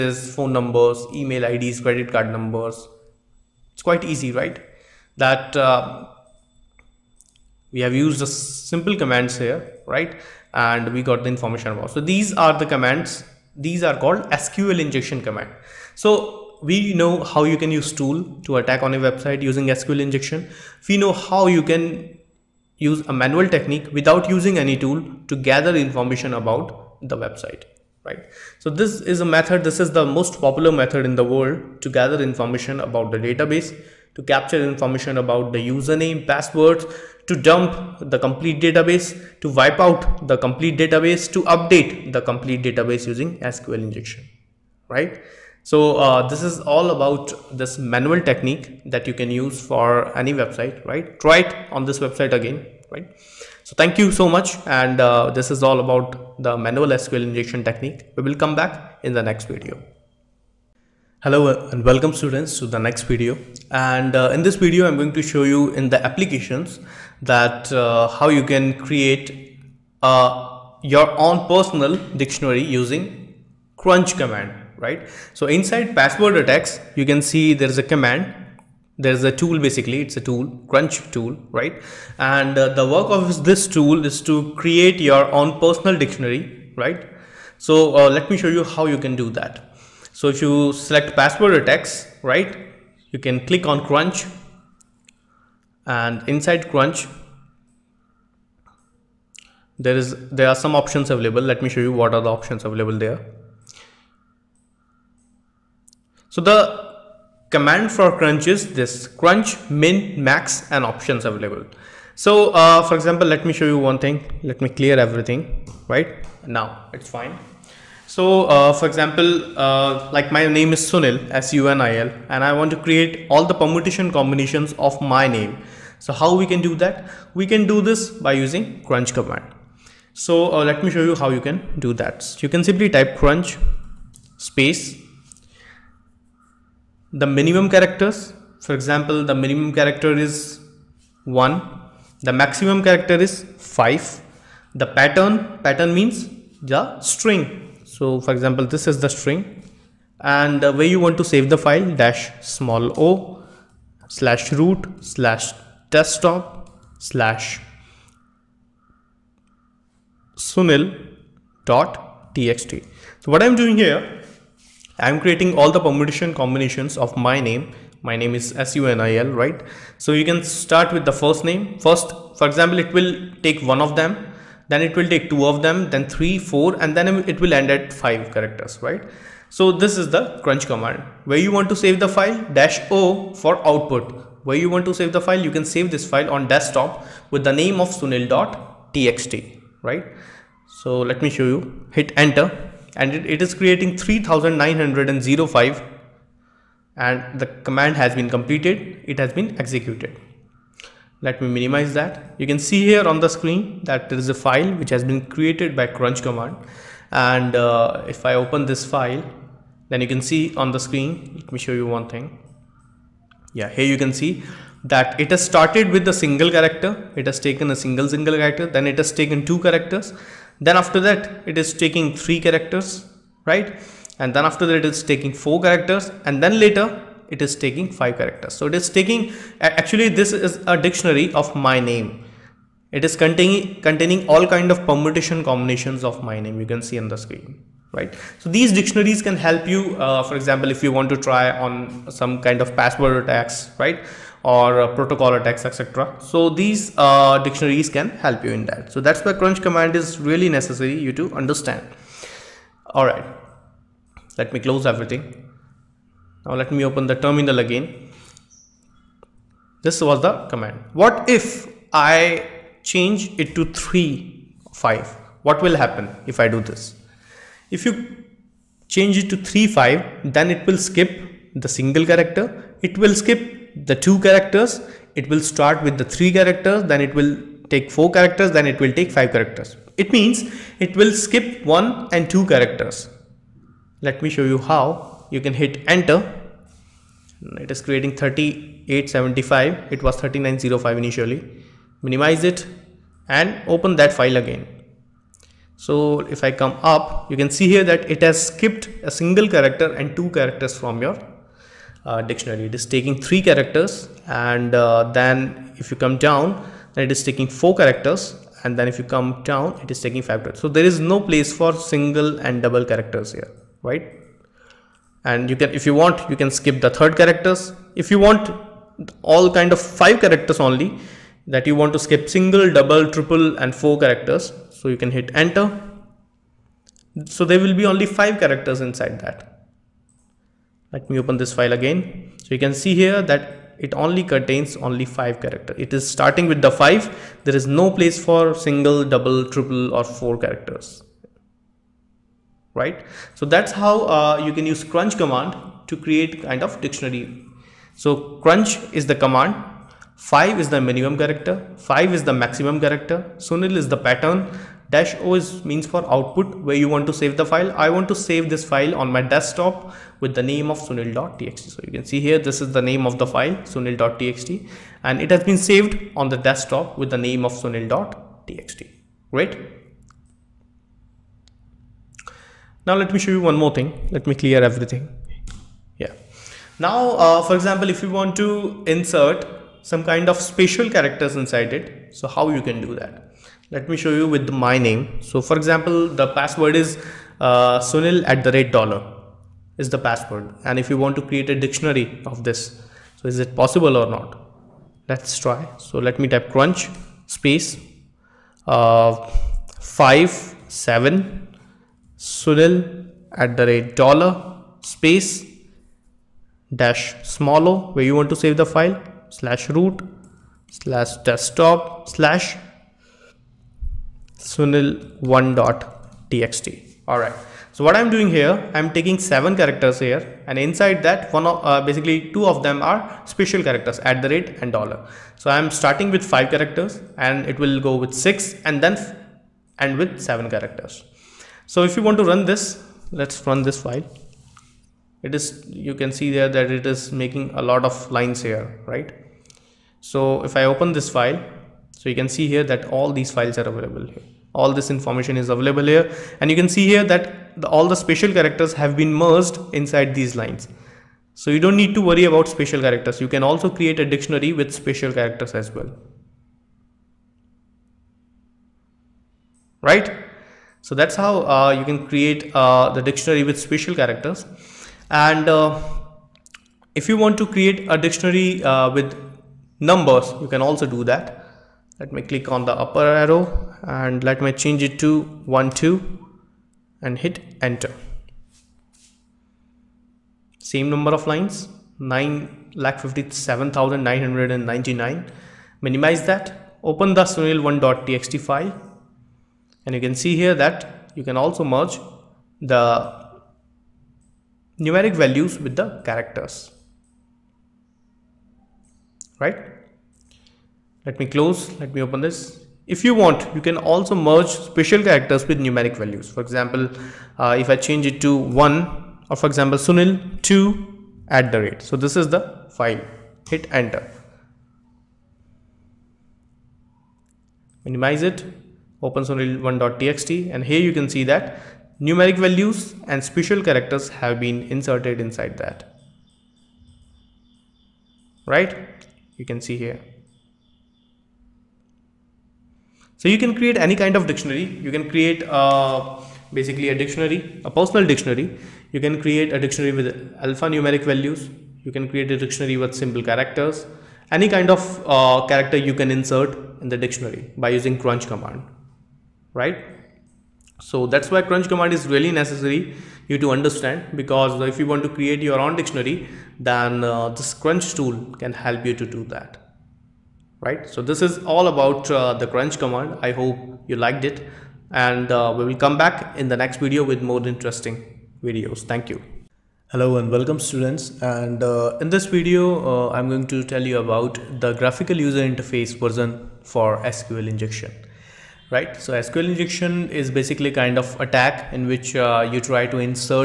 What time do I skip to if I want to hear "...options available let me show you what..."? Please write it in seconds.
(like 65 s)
100 s.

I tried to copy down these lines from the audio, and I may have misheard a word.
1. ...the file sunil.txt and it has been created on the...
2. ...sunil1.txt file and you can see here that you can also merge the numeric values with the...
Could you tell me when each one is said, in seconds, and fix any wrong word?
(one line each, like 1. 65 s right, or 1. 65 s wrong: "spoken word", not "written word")
1. 363 s wrong: "saved", not "created"
2. 487 s right.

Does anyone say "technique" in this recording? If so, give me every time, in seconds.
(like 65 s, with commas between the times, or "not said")
23 s, 48 s, 57 s.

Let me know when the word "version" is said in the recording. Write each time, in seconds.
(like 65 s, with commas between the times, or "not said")
575 s.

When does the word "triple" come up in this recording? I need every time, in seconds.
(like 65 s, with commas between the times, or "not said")
323 s, 339 s.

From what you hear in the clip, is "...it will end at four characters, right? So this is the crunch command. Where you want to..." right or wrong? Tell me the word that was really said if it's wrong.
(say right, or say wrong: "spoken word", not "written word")
wrong: "five", not "four".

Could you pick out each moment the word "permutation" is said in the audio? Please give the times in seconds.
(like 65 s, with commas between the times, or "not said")
123 s, 165 s, 234 s.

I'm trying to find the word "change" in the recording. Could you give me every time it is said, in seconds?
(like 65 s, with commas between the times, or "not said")
262 s, 268 s, 474 s, 507 s.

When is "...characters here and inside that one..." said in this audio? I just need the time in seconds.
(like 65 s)
419 s.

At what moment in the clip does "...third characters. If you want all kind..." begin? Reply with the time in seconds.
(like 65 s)
316 s.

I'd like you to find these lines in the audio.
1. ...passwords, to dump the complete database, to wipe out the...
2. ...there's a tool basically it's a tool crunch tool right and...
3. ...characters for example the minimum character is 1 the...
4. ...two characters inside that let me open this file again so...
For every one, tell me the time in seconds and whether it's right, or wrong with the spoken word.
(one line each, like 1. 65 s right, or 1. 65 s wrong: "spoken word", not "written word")
1. 36 s right
2. 78 s right
3. 137 s right
4. 328 s wrong: "five", not "two".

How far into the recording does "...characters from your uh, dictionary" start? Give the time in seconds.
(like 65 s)
300 s.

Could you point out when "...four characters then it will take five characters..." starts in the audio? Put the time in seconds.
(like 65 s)
277 s.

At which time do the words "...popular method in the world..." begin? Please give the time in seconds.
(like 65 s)
30 s.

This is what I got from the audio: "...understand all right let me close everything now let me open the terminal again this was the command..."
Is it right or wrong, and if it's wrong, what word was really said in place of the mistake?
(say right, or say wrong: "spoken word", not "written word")
right.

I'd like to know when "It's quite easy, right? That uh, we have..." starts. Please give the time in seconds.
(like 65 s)
3 s.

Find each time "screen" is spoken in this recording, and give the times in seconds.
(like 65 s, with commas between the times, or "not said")
203 s, 210 s, 237 s.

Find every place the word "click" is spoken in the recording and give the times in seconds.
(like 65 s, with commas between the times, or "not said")
93 s, 472 s.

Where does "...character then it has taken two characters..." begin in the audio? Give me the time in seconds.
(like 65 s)
218 s.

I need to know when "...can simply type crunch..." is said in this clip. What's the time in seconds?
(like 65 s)
132 s.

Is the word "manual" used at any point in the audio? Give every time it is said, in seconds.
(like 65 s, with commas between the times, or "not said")
23 s, 47 s, 56 s.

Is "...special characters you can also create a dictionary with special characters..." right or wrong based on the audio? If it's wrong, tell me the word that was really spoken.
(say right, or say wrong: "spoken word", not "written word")
right.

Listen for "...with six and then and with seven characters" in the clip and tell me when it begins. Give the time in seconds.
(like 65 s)
428 s.